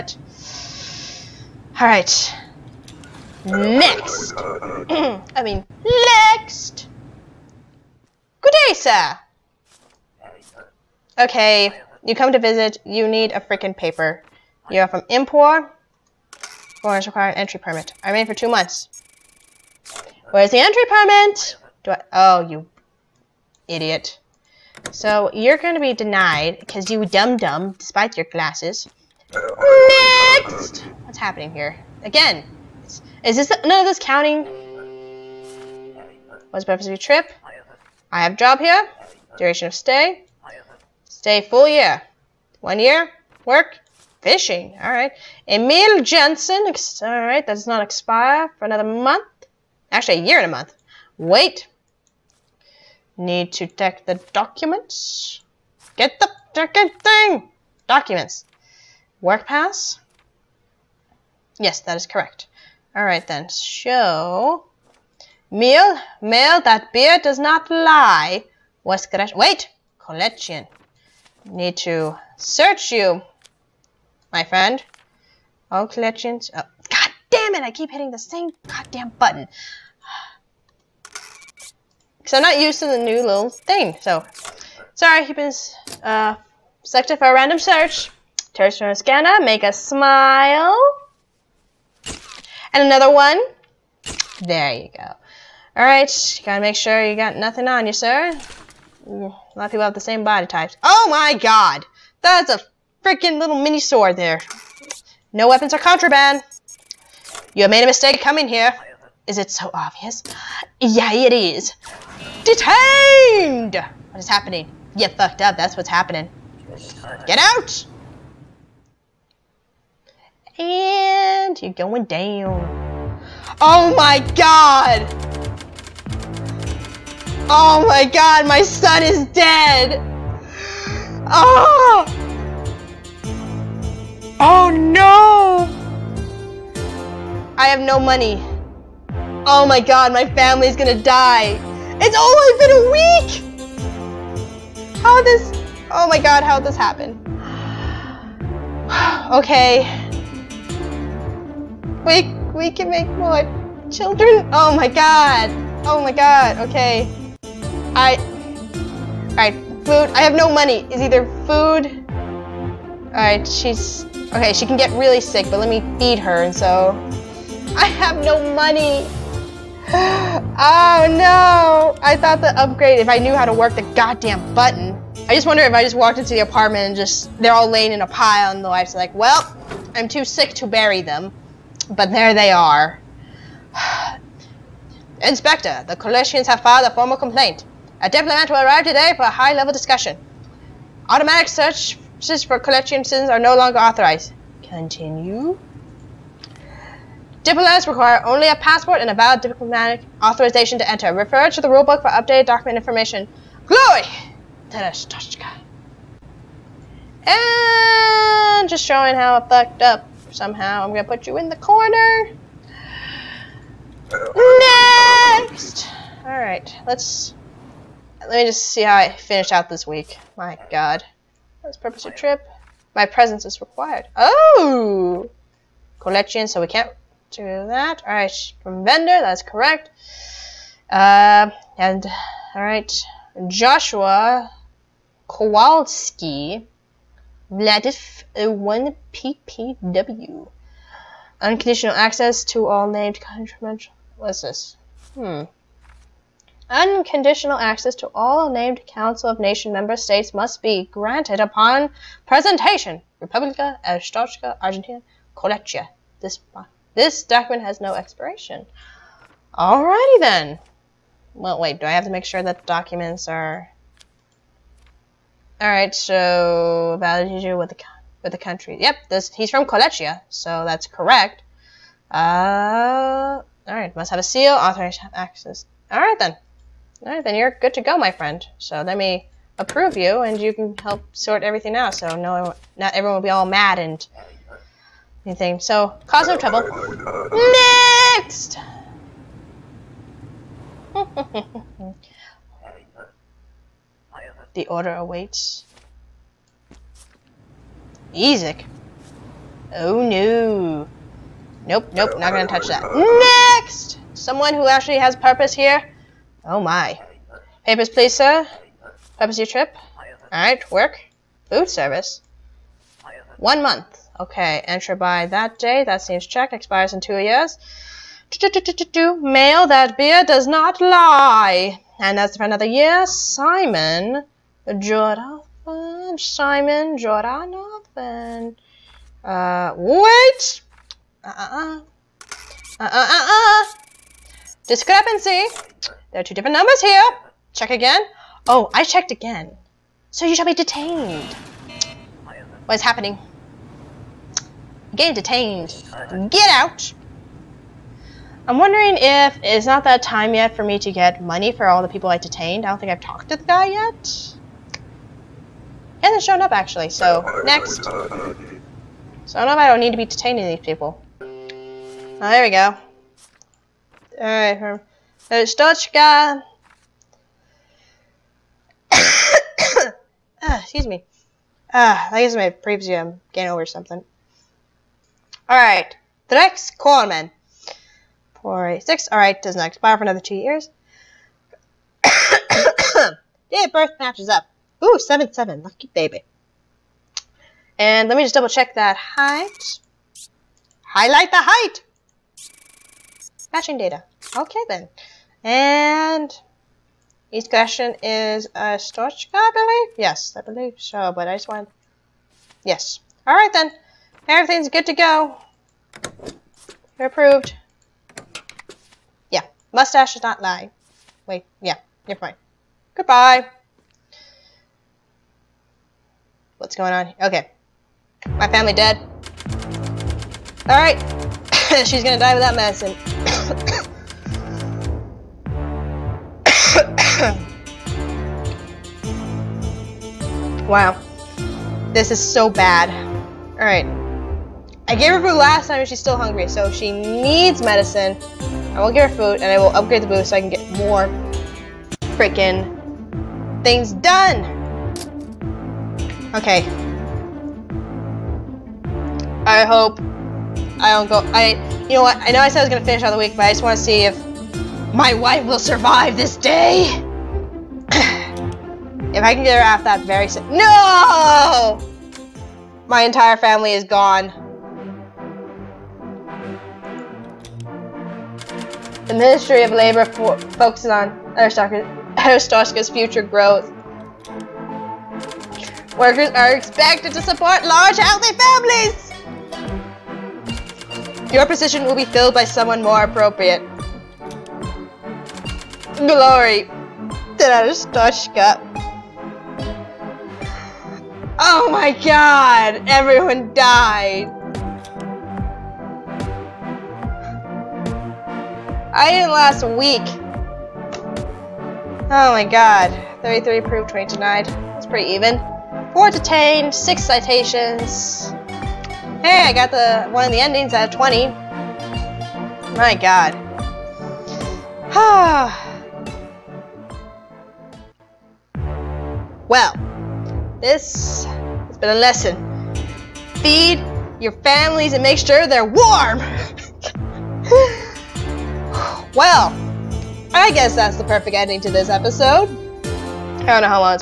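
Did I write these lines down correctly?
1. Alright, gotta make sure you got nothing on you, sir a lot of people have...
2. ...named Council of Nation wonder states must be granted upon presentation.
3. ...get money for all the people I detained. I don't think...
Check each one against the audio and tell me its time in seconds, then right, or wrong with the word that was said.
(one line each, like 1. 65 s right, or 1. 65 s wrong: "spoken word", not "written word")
1. 95 s right
2. 248 s wrong: "member", not "wonder"
3. 350 s right.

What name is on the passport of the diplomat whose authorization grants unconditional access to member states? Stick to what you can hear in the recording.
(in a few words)
Joshua Kowalski.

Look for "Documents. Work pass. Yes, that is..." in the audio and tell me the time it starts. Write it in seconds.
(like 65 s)
57 s.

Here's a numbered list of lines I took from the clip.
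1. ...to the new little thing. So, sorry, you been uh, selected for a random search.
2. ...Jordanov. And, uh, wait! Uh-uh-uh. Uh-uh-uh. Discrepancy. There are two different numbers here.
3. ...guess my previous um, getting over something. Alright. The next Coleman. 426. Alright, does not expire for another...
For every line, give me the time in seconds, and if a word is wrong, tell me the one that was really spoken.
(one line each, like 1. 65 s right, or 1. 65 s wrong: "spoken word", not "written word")
1. 82 s right
2. 326 s right
3. 372 s wrong: "486", not "426".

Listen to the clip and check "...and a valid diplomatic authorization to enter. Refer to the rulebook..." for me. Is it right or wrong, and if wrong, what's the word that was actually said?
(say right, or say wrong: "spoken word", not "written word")
right.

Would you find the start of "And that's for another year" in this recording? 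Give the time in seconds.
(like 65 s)
321 s.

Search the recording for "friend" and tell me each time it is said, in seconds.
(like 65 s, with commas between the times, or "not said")
74 s, 278 s.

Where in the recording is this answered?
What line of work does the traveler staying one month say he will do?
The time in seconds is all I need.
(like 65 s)
311 s.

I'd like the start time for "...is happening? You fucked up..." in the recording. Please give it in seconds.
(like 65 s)
114 s.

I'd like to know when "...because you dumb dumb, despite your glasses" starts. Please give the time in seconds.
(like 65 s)
26 s.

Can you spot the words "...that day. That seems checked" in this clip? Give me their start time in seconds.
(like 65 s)
315 s.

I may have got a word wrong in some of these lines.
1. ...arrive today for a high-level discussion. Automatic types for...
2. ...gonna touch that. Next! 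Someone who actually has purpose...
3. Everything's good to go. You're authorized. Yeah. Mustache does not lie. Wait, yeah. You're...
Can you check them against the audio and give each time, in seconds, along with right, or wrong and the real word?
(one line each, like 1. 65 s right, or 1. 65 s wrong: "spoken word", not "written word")
1. 188 s wrong: "searches", not "types"
2. 302 s right
3. 404 s wrong: "approved", not "authorized".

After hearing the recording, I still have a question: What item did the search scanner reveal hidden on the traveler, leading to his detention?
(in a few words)
mini sword.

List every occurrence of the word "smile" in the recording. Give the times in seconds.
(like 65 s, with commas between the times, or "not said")
89 s.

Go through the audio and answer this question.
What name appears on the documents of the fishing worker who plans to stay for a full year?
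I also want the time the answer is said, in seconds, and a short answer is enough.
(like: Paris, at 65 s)
Emil Jensen, at 45 s.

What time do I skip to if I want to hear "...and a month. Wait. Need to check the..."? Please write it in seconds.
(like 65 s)
50 s.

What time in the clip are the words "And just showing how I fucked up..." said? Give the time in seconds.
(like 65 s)
204 s.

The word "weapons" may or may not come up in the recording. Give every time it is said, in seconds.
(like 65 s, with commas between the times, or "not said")
105 s.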